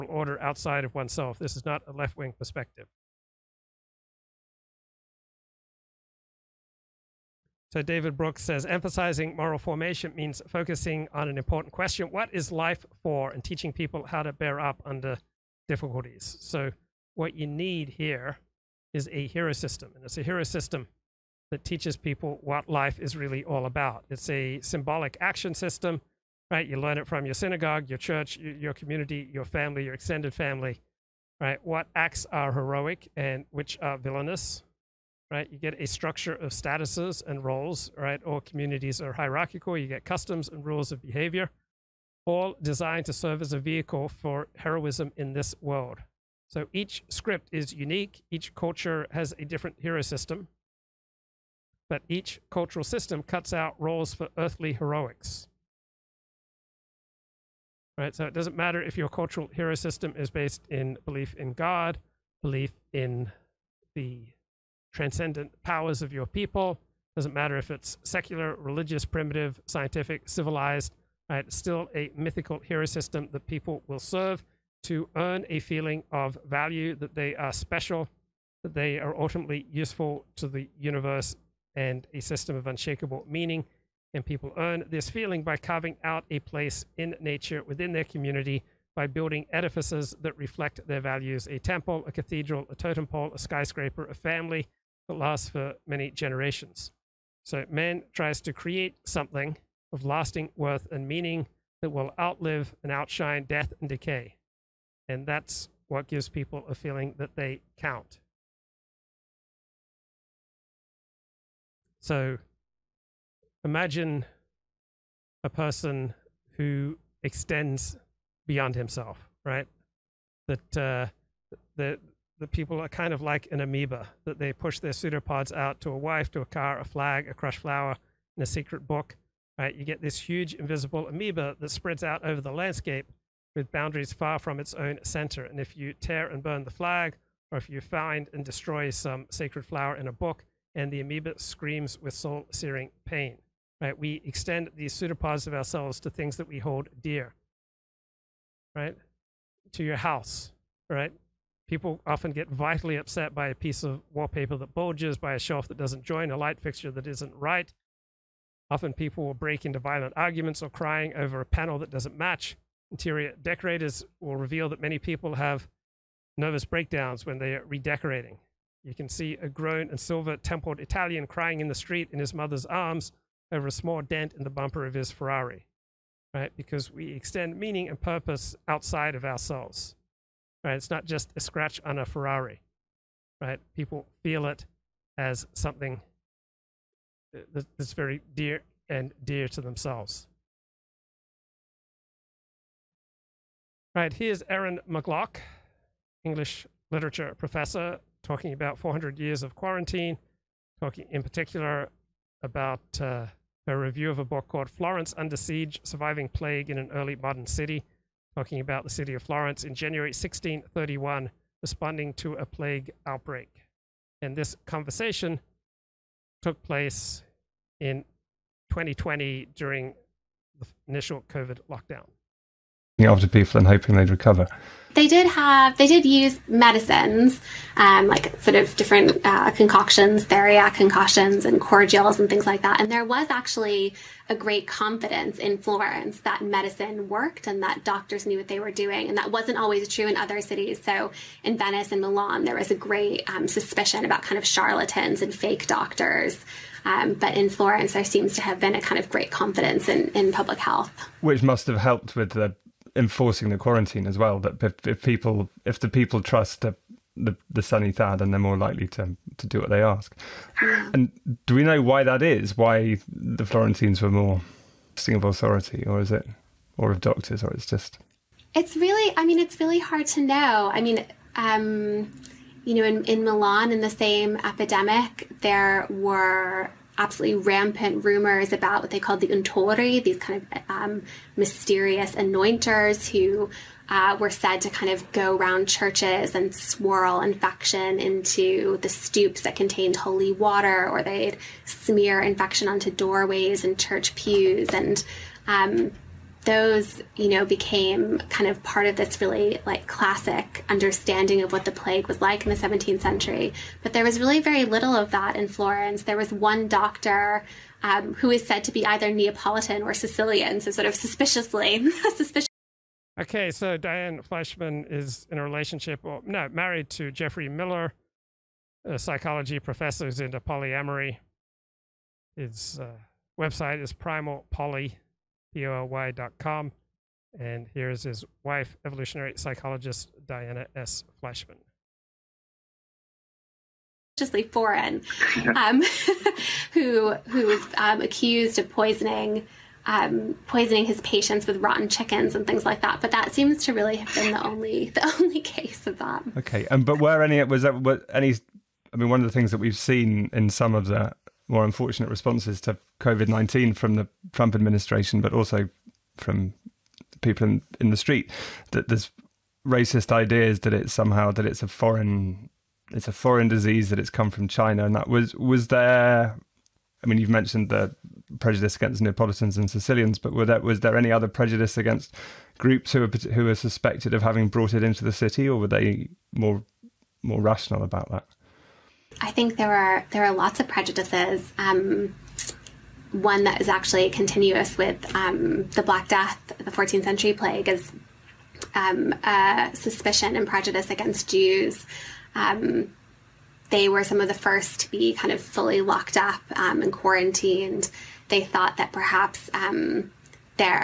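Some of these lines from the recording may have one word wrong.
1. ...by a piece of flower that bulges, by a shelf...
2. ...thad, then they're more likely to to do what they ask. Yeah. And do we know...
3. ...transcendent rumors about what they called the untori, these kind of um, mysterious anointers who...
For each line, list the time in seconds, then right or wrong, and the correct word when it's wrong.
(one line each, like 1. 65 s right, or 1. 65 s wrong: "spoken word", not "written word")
1. 153 s wrong: "wallpaper", not "flower"
2. 257 s right
3. 277 s wrong: "rampant", not "transcendent".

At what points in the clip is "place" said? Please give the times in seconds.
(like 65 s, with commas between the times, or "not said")
86 s, 216 s.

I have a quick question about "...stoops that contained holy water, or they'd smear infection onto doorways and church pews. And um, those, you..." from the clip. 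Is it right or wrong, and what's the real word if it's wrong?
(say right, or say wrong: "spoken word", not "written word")
right.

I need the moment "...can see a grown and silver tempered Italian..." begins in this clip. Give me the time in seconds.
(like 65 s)
168 s.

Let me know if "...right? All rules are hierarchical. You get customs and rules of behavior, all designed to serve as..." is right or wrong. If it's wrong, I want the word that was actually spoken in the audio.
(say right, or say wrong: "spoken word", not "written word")
wrong: "communities", not "rules".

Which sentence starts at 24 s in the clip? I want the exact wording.
It's a symbolic action system, right?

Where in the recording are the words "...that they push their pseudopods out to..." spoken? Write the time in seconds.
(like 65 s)
124 s.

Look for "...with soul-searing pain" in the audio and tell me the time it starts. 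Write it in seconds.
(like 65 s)
141 s.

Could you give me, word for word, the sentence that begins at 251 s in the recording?
Which must have helped with the enforcing the quarantine as well.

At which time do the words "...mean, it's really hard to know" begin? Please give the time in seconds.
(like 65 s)
269 s.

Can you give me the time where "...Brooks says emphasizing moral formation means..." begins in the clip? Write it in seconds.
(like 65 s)
8 s.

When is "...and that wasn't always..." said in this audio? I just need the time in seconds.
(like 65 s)
239 s.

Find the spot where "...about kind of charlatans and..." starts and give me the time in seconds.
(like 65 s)
244 s.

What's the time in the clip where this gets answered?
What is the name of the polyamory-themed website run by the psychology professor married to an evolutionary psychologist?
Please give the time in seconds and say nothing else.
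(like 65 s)
323 s.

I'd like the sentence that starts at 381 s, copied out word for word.
Um, one that is actually continuous with um, the Black Death, the 14th century plague, is um, suspicion and prejudice against Jews.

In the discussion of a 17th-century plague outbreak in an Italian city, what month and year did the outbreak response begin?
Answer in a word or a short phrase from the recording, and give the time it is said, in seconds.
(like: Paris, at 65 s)
January 1631, at 209 s.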